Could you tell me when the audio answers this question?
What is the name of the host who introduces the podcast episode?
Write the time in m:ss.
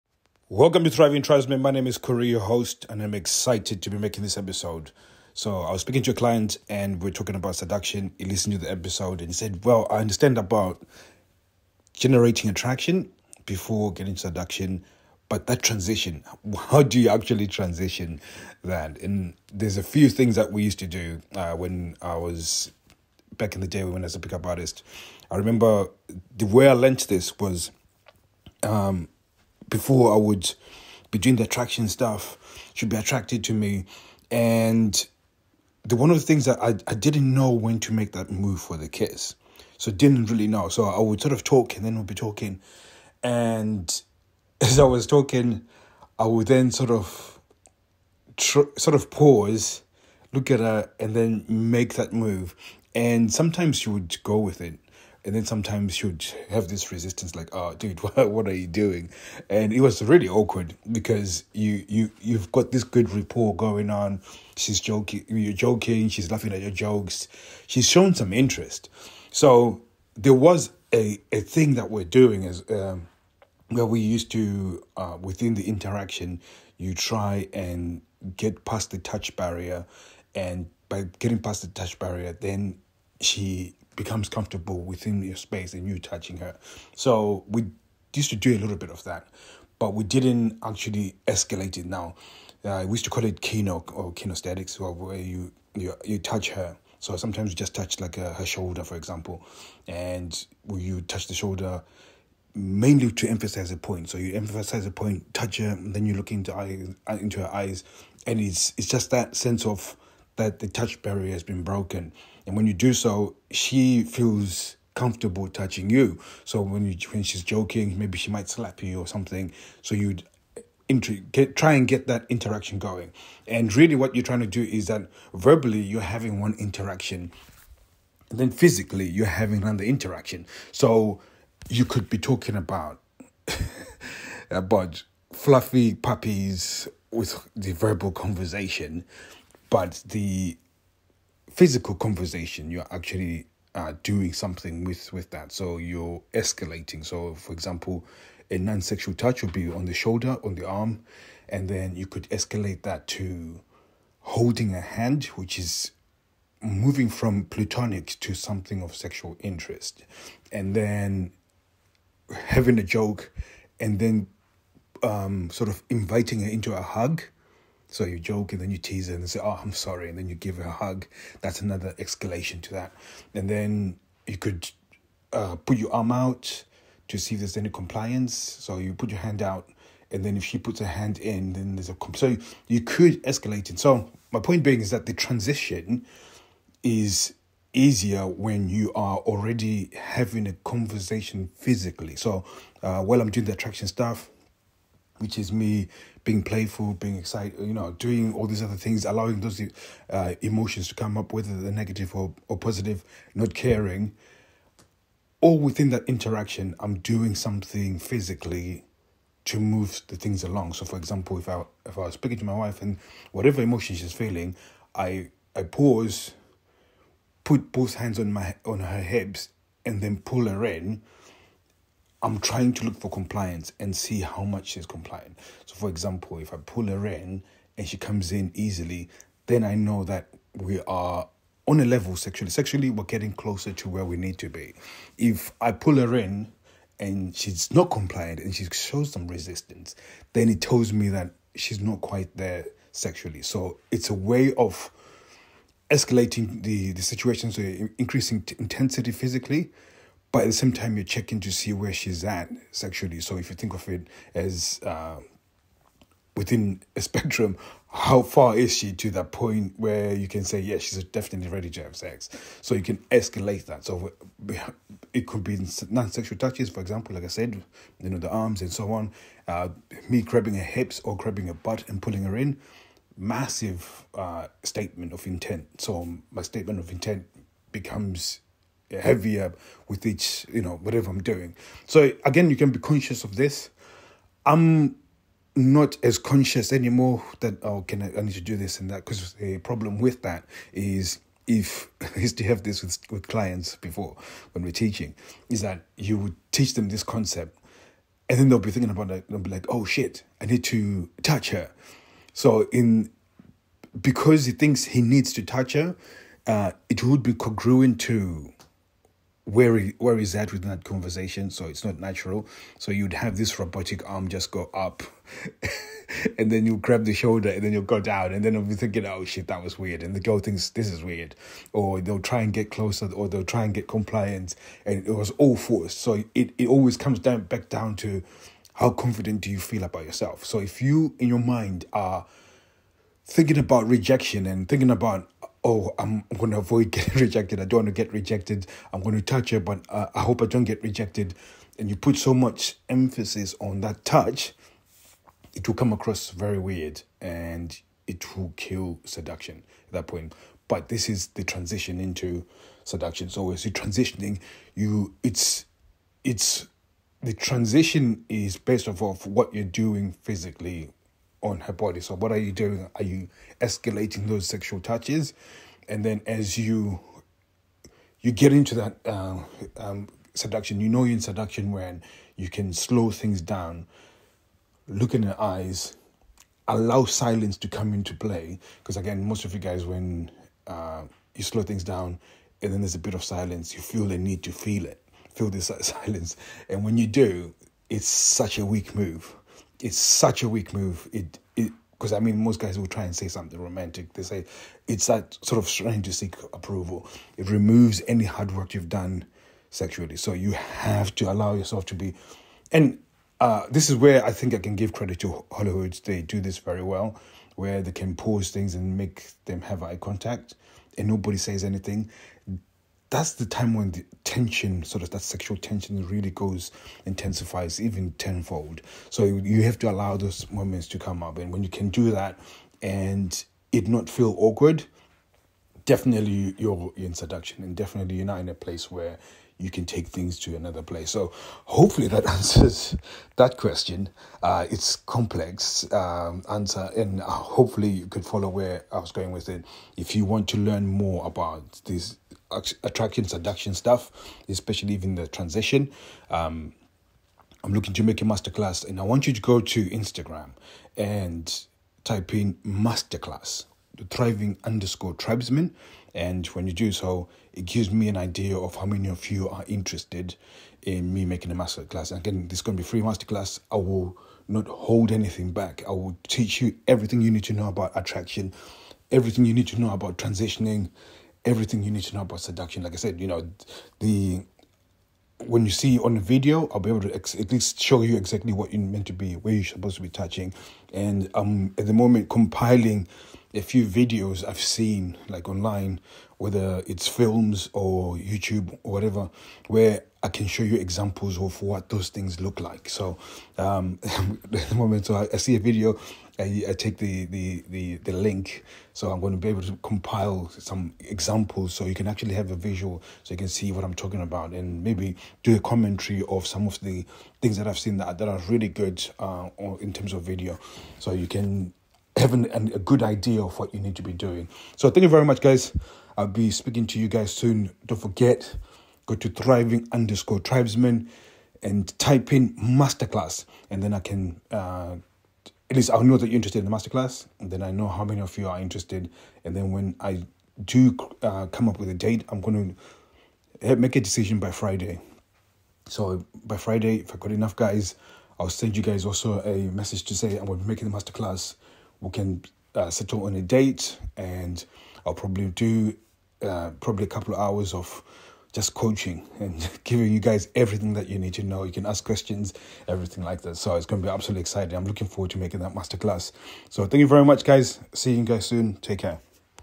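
0:01.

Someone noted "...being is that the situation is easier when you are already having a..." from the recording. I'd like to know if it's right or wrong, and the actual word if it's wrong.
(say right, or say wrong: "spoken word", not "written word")
wrong: "transition", not "situation".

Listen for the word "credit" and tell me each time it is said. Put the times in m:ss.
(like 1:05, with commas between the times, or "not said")
6:44.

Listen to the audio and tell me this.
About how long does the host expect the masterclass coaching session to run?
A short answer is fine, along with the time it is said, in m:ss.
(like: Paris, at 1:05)
a couple of hours, at 9:07.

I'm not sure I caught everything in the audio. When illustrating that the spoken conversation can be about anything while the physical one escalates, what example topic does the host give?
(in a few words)
fluffy puppies.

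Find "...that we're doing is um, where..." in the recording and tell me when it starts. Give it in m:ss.
1:11.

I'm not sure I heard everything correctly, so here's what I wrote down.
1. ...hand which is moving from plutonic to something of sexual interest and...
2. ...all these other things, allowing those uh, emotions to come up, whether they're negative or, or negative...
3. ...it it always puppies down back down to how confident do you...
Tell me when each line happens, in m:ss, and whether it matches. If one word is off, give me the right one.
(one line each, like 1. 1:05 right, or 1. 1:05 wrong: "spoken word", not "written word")
1. 2:34 right
2. 3:18 wrong: "positive", not "negative"
3. 5:26 wrong: "comes", not "puppies".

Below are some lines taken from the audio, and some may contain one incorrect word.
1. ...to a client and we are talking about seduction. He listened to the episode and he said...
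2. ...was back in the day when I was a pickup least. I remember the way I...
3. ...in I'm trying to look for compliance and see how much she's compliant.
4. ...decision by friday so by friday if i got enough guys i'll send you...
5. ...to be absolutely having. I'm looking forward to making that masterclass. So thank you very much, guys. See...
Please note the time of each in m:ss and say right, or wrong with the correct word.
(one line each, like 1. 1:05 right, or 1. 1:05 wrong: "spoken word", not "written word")
1. 0:06 right
2. 0:22 wrong: "artist", not "least"
3. 3:40 right
4. 8:54 right
5. 9:14 wrong: "exciting", not "having".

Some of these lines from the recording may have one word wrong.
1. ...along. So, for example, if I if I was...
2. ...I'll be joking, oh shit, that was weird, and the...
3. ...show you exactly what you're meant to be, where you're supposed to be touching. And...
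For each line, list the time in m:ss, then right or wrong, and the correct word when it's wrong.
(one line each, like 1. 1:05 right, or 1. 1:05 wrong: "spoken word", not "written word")
1. 3:30 right
2. 5:18 wrong: "thinking", not "joking"
3. 7:57 right.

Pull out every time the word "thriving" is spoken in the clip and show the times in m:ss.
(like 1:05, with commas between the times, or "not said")
0:00, 7:34, 8:39.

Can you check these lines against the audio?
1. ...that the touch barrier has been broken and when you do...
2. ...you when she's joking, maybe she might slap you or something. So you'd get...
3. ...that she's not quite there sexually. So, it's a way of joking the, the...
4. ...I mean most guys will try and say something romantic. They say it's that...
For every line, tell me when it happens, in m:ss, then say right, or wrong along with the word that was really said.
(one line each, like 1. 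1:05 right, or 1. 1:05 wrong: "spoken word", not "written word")
1. 1:50 right
2. 1:56 right
3. 4:01 wrong: "escalating", not "joking"
4. 6:32 right.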